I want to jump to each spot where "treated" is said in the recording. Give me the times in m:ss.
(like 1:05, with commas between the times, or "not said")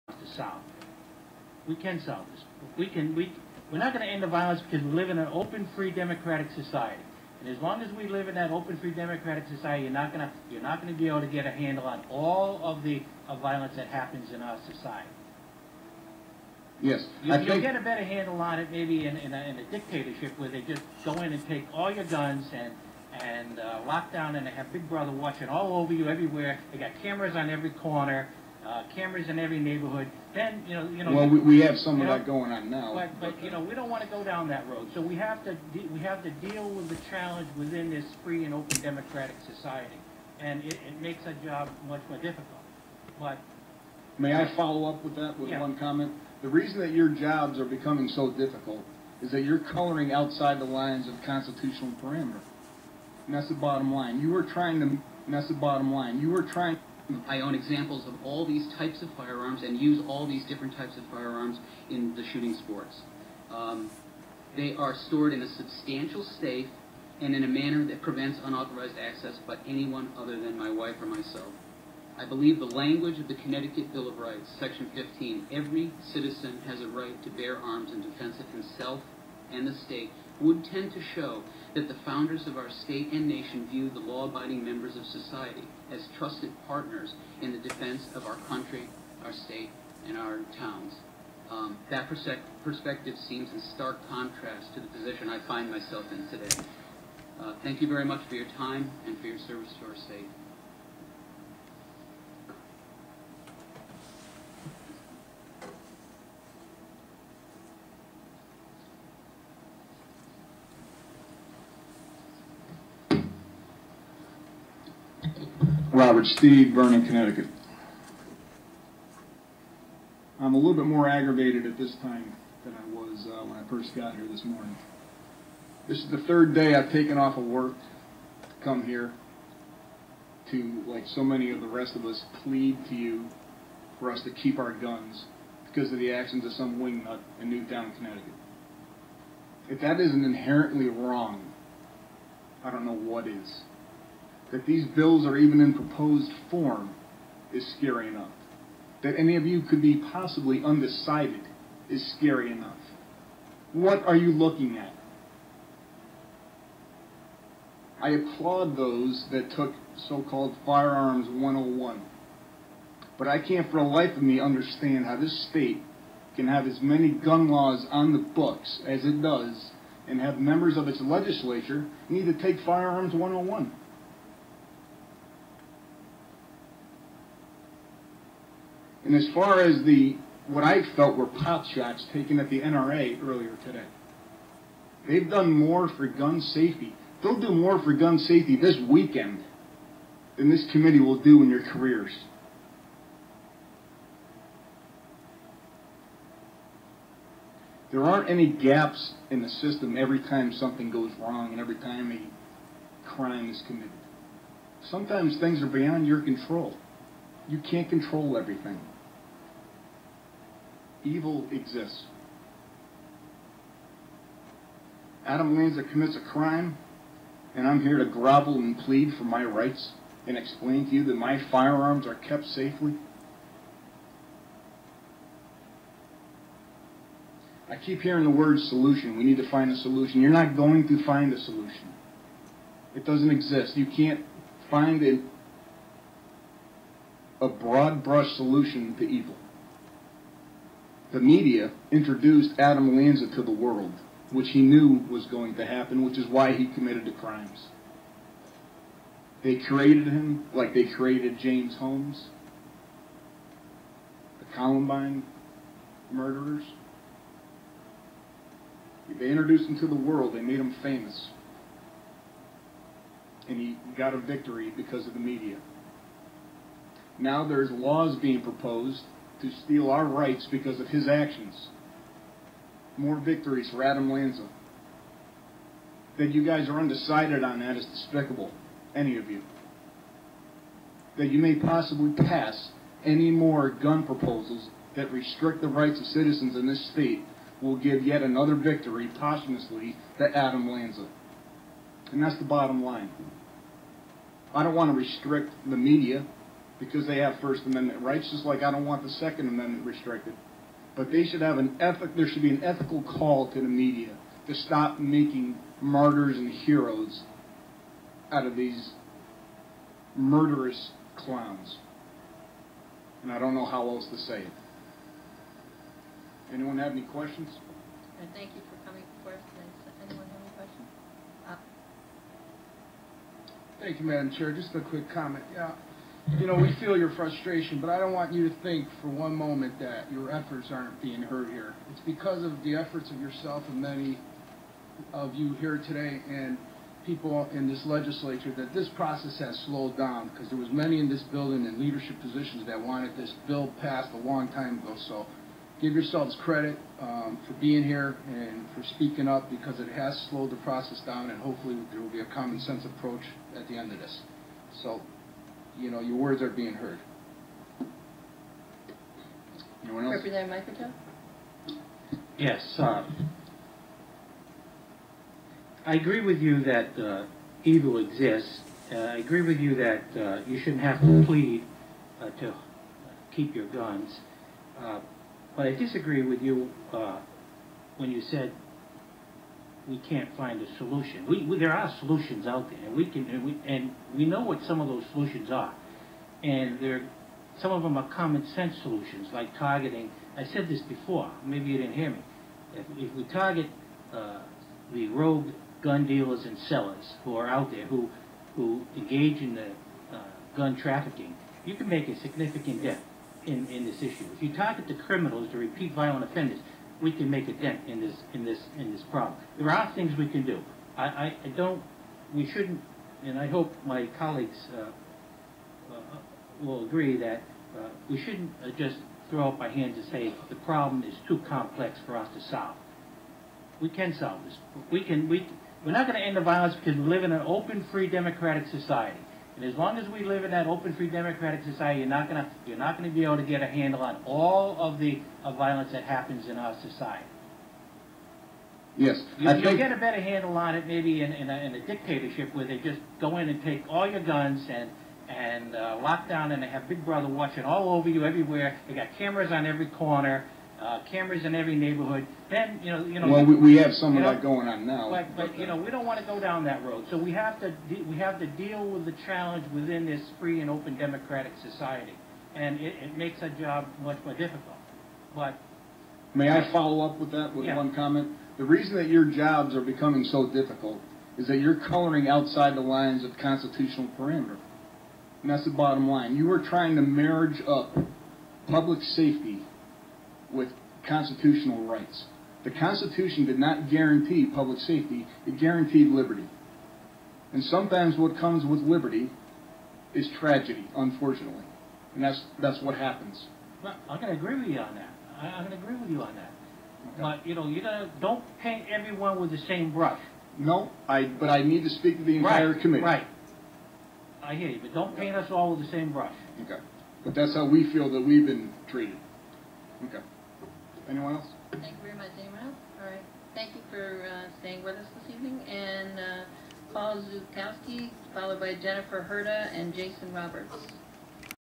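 8:28.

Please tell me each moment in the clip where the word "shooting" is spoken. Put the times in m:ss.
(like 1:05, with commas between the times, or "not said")
1:02.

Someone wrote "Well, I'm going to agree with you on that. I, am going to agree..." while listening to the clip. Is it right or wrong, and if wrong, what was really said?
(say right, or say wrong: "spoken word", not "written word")
right.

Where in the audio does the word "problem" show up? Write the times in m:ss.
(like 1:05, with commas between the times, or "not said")
6:49, 7:00.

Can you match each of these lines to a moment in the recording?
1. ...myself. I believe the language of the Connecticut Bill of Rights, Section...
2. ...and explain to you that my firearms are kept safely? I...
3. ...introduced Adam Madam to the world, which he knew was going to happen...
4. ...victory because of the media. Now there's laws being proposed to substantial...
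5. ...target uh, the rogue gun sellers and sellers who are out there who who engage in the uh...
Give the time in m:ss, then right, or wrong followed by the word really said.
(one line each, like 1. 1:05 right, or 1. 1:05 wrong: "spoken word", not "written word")
1. 1:11 right
2. 3:40 right
3. 4:01 wrong: "Lanza", not "Madam"
4. 4:24 wrong: "steal", not "substantial"
5. 6:33 wrong: "dealers", not "sellers".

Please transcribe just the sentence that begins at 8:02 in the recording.
The Constitution did not guarantee public safety, it guaranteed liberty.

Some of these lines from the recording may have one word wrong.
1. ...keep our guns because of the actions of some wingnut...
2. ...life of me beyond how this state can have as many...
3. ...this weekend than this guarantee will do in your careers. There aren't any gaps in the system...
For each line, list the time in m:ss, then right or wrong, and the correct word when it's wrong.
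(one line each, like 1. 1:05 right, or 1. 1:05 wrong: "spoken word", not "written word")
1. 2:14 right
2. 2:43 wrong: "understand", not "beyond"
3. 3:08 wrong: "committee", not "guarantee".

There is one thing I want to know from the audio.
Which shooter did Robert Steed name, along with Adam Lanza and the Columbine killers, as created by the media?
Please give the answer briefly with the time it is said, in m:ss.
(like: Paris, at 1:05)
James Holmes, at 4:11.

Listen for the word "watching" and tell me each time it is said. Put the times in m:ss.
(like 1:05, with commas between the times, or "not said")
0:25, 7:27.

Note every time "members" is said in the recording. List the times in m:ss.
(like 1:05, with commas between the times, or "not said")
1:24, 2:50.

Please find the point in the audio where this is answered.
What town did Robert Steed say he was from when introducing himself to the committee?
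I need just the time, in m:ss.
1:56.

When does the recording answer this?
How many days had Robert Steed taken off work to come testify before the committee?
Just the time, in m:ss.
2:06.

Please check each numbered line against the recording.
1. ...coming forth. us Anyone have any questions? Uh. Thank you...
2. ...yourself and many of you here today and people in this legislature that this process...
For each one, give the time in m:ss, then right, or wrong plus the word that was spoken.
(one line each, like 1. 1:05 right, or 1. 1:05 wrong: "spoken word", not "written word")
1. 5:18 right
2. 5:33 right.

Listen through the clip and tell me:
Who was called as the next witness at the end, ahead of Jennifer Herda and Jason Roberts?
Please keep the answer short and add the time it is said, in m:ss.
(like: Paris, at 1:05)
Paul Zukowski, at 8:36.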